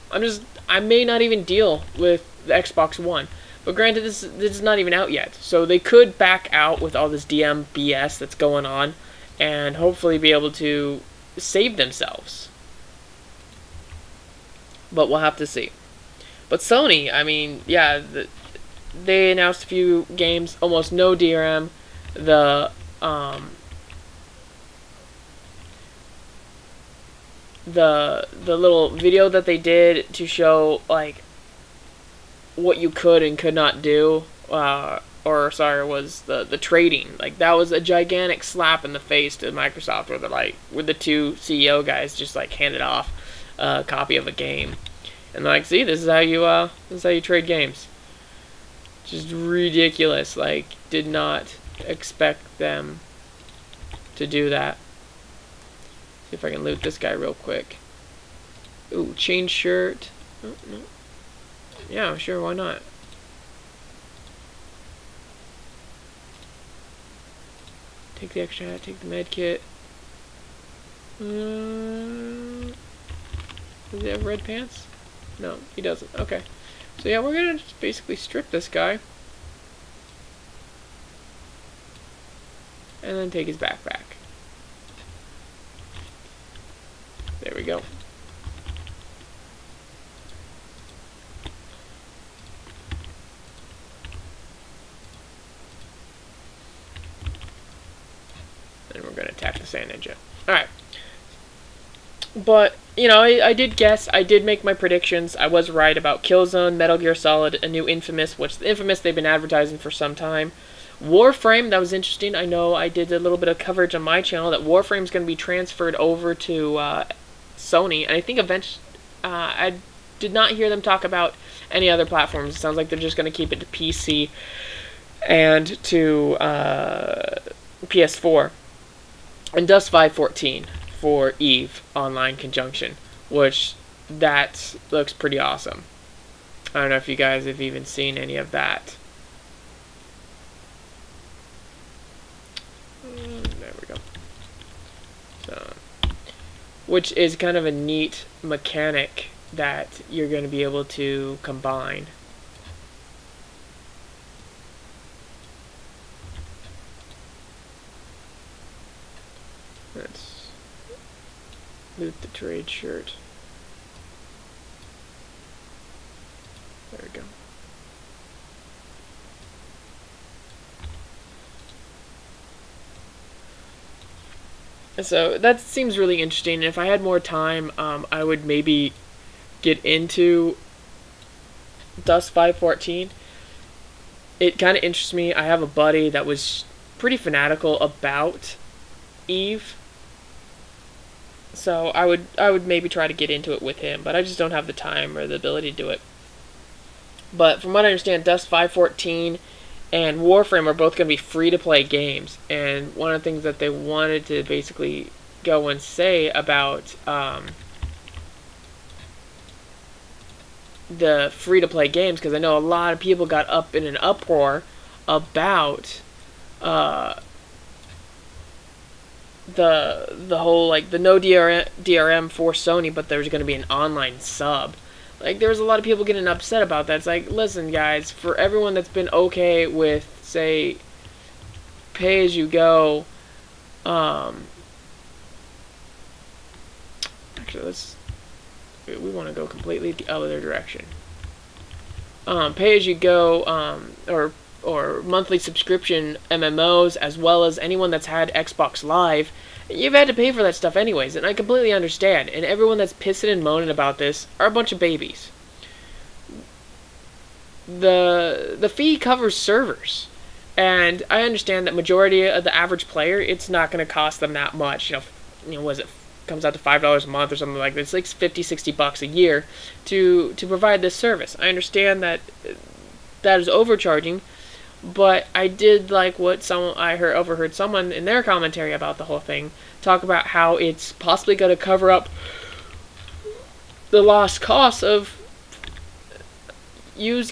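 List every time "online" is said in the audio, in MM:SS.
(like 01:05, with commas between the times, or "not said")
02:11, 03:43.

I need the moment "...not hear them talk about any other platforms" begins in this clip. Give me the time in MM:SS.
02:00.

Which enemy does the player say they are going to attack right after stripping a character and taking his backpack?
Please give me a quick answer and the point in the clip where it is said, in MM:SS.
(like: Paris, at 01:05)
Sand Ninja, at 01:39.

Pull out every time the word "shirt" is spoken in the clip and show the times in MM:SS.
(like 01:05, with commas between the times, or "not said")
00:59, 02:42.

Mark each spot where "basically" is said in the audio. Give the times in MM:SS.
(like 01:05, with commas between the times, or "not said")
01:17, 03:24.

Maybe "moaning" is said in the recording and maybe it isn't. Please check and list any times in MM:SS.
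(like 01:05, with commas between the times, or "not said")
04:13.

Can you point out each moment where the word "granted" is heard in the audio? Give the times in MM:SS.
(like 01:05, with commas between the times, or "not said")
00:03.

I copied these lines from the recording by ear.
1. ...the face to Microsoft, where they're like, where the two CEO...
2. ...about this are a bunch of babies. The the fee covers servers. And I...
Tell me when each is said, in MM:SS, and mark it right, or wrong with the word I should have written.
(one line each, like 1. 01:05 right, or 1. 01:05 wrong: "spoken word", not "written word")
1. 00:38 right
2. 04:13 right.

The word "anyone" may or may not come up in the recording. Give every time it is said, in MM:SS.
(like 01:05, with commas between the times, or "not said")
04:07.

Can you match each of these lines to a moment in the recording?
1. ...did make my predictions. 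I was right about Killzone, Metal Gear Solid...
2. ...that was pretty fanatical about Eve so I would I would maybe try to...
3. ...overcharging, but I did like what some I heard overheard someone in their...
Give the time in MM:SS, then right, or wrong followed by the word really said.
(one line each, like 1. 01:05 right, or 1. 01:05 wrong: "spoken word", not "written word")
1. 01:44 right
2. 03:06 right
3. 04:33 right.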